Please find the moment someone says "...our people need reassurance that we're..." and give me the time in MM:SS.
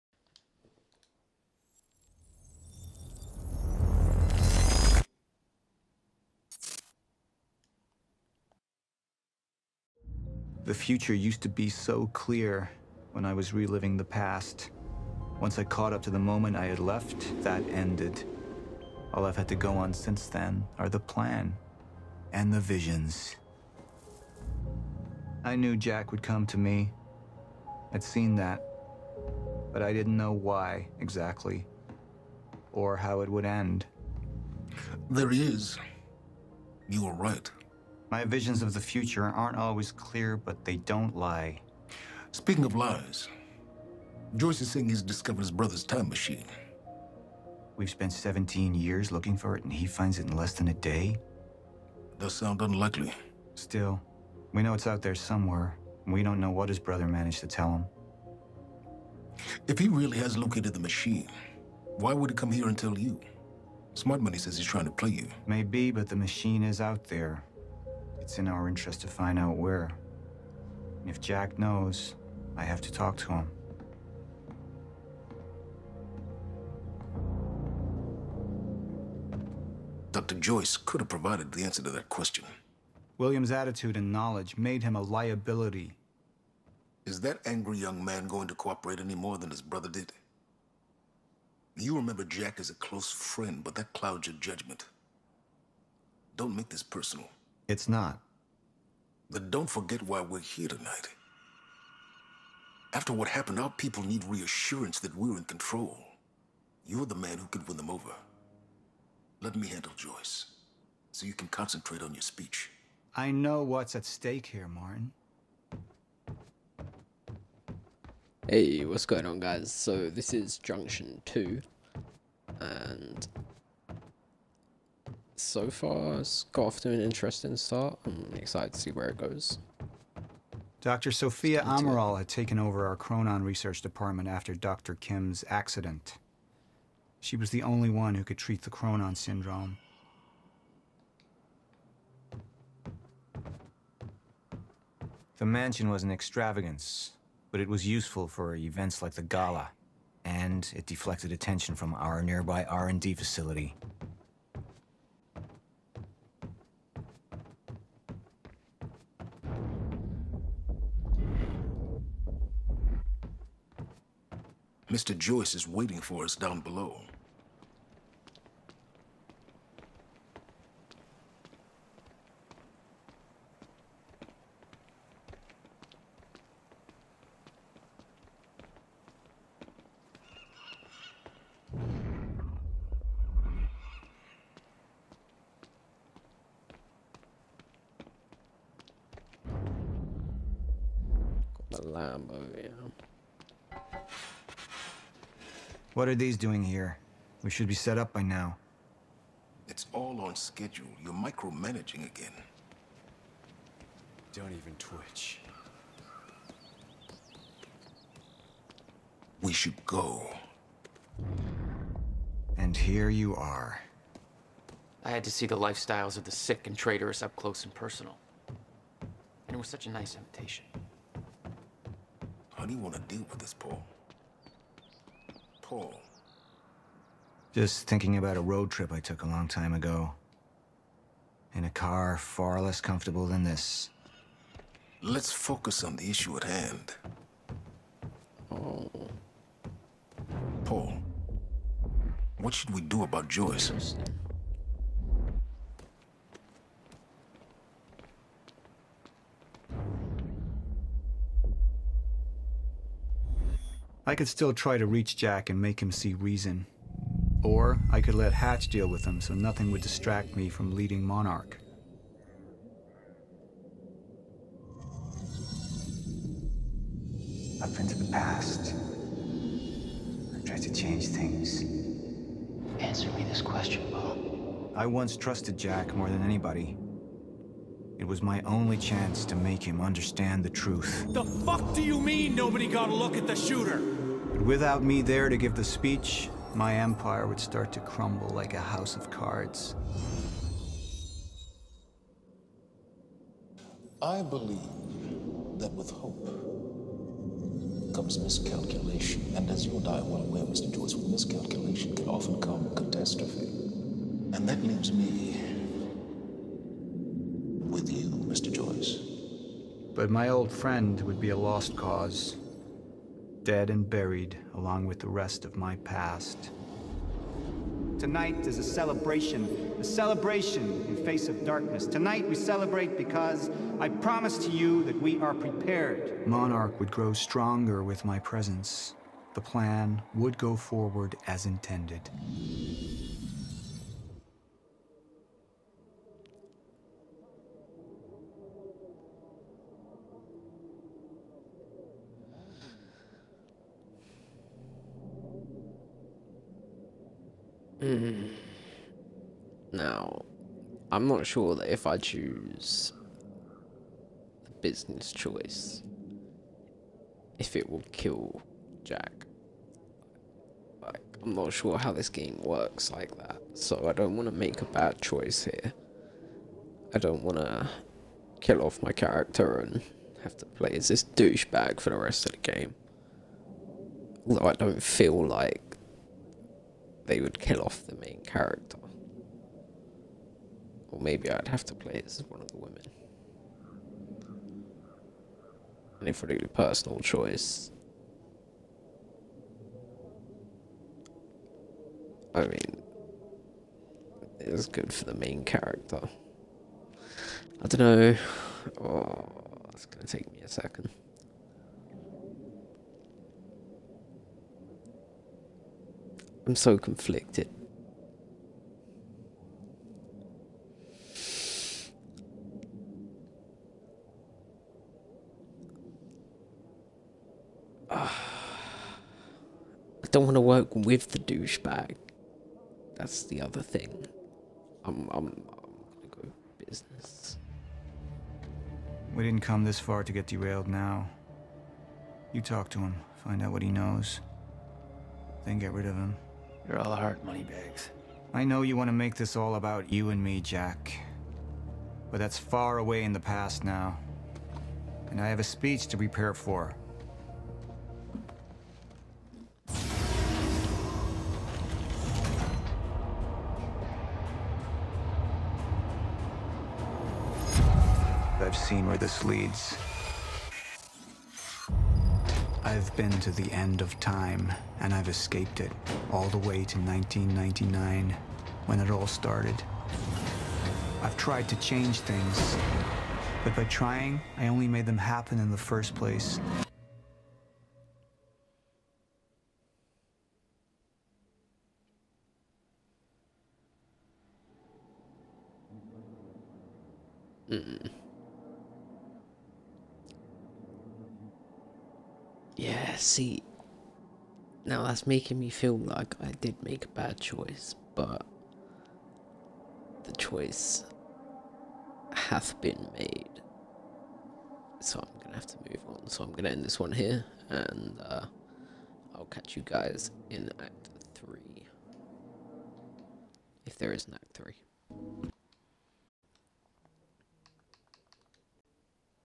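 01:43.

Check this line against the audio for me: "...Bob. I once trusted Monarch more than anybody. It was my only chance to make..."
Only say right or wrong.
wrong.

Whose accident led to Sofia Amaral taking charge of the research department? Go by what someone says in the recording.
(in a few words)
Dr. Kim.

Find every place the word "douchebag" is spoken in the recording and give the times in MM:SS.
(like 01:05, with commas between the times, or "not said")
06:11, 07:01.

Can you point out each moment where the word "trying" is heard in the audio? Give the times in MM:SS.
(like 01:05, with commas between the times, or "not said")
01:04, 07:53.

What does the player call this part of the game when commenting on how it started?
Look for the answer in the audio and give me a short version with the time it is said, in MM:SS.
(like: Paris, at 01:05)
Junction 2, at 02:00.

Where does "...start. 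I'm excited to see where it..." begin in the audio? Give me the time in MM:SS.
02:07.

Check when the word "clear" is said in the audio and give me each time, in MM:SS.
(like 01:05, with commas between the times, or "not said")
00:12, 00:39.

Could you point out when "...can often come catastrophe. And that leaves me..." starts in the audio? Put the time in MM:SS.
05:01.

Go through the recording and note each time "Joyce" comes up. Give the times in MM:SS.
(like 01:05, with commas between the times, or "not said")
00:44, 01:20, 01:49, 02:45, 04:03, 05:00, 05:08.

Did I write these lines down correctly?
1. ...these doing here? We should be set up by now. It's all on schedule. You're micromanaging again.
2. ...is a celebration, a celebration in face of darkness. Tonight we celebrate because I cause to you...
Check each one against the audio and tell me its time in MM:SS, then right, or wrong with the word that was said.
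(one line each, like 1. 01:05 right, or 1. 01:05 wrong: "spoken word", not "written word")
1. 03:16 right
2. 05:18 wrong: "promise", not "cause".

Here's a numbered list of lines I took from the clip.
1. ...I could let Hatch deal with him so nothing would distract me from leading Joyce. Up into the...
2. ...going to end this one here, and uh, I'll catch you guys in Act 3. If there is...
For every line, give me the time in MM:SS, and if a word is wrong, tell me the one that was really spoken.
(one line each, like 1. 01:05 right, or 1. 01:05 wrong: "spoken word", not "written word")
1. 04:17 wrong: "Monarch", not "Joyce"
2. 08:26 right.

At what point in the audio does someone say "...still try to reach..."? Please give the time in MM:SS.
04:14.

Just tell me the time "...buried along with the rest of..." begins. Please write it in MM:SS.
05:13.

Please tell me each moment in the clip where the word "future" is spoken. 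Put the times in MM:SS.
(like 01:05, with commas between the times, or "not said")
00:10, 00:38.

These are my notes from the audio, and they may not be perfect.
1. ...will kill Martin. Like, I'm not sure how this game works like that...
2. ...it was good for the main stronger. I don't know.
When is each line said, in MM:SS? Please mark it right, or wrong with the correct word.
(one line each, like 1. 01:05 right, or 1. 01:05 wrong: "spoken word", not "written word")
1. 05:57 wrong: "Jack", not "Martin"
2. 06:34 wrong: "character", not "stronger".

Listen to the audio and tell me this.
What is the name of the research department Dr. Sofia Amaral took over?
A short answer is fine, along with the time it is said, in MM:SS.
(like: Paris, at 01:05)
Chronon research department, at 02:12.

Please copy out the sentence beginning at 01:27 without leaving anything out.
Is that angry young man going to cooperate any more than his brother did?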